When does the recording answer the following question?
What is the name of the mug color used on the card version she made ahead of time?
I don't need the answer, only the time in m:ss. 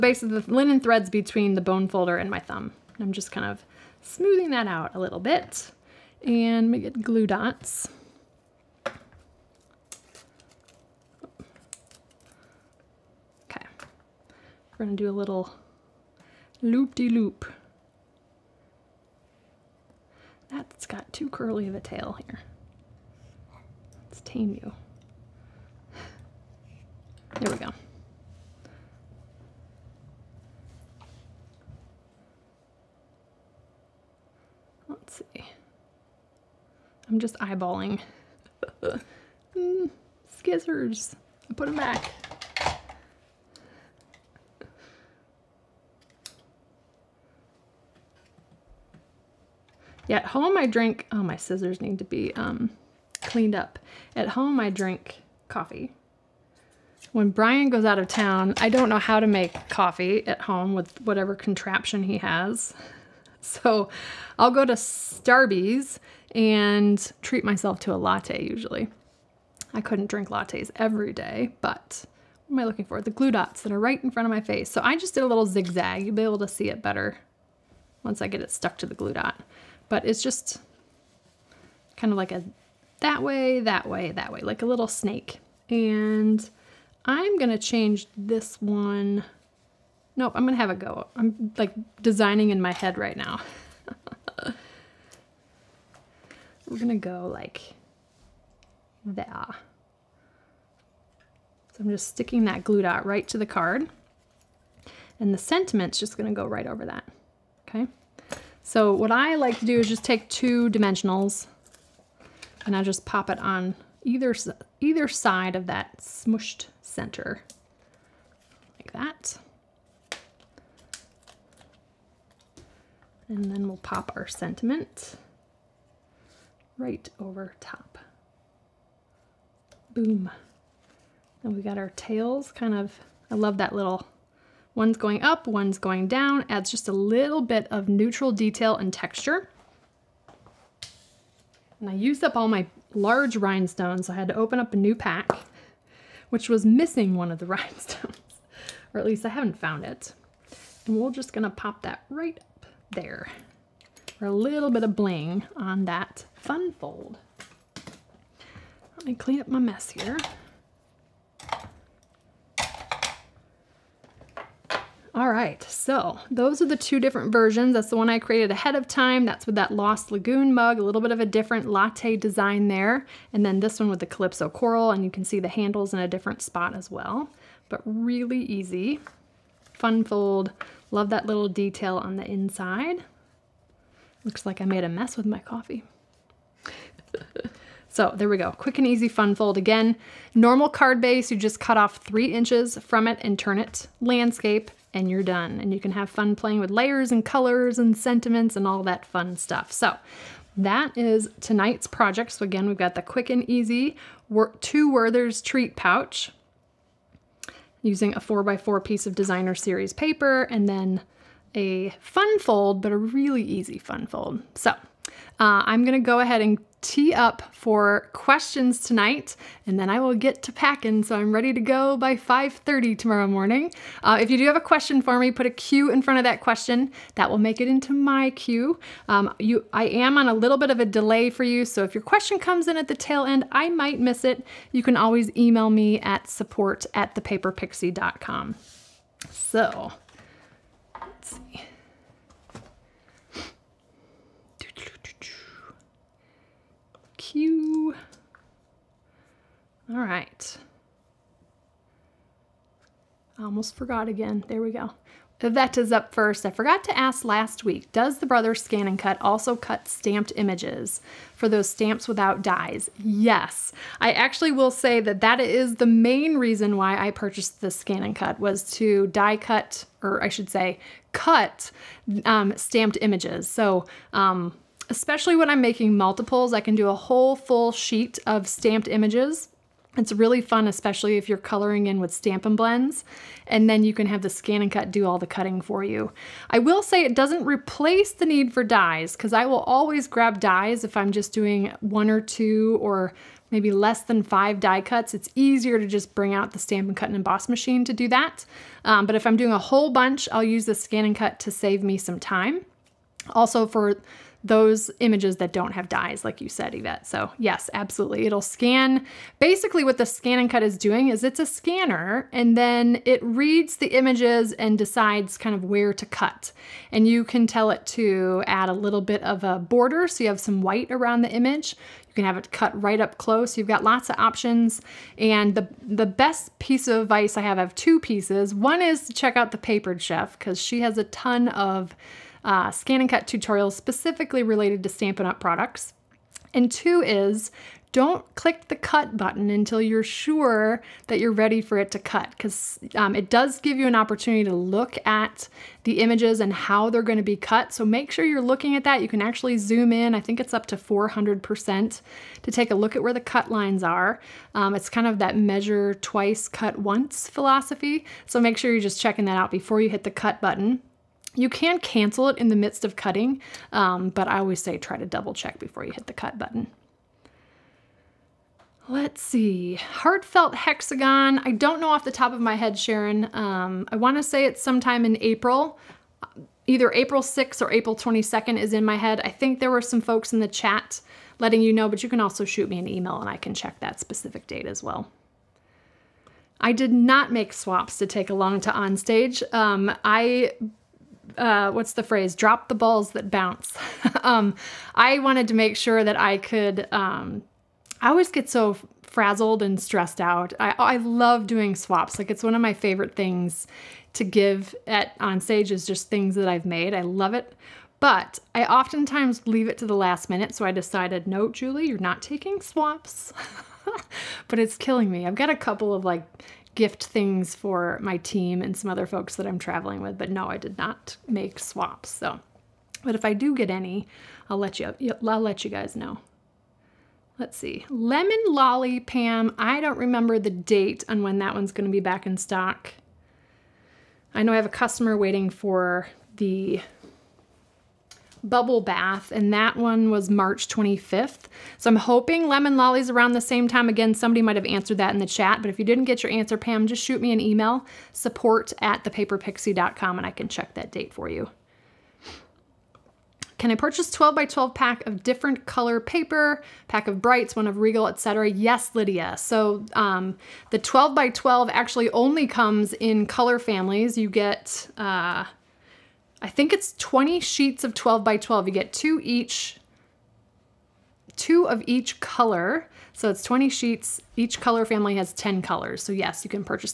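2:49.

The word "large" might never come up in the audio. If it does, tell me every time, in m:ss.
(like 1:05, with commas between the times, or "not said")
2:22.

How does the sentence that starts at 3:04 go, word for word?
Looks like I made a mess with my coffee.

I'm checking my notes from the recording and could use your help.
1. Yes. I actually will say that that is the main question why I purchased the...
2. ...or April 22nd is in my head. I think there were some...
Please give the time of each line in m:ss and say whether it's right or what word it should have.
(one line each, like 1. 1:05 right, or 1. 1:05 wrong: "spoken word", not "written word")
1. 4:23 wrong: "reason", not "question"
2. 6:17 right.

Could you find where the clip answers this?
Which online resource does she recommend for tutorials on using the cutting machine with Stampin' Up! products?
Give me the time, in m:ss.
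5:29.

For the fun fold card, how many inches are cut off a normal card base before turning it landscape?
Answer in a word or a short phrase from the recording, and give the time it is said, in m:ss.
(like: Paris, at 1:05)
3, at 3:11.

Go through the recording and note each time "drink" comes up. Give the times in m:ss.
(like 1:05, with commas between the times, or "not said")
0:50, 0:54, 1:10.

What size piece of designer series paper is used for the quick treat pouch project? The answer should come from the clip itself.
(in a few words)
4 by 4.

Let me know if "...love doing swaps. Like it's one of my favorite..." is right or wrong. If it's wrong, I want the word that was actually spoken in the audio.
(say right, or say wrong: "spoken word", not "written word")
right.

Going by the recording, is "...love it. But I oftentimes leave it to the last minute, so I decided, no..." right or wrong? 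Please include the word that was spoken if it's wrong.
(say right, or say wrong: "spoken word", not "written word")
right.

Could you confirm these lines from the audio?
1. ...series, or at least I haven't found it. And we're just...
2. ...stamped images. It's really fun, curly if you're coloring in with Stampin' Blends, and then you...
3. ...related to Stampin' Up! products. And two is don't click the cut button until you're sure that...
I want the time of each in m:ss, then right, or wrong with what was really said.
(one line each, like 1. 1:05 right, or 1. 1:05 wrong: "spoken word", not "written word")
1. 2:27 wrong: "rhinestones", not "series"
2. 4:38 wrong: "especially", not "curly"
3. 5:34 right.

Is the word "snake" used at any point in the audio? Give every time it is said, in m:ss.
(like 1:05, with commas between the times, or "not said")
1:24.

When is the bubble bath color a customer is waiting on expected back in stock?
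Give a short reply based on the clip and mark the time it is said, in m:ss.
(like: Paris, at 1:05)
March 25th, at 7:20.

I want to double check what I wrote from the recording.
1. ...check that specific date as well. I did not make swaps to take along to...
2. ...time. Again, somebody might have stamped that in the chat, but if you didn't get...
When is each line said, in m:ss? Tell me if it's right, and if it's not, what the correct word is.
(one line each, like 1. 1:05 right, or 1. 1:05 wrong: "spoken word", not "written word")
1. 6:23 right
2. 7:23 wrong: "answered", not "stamped".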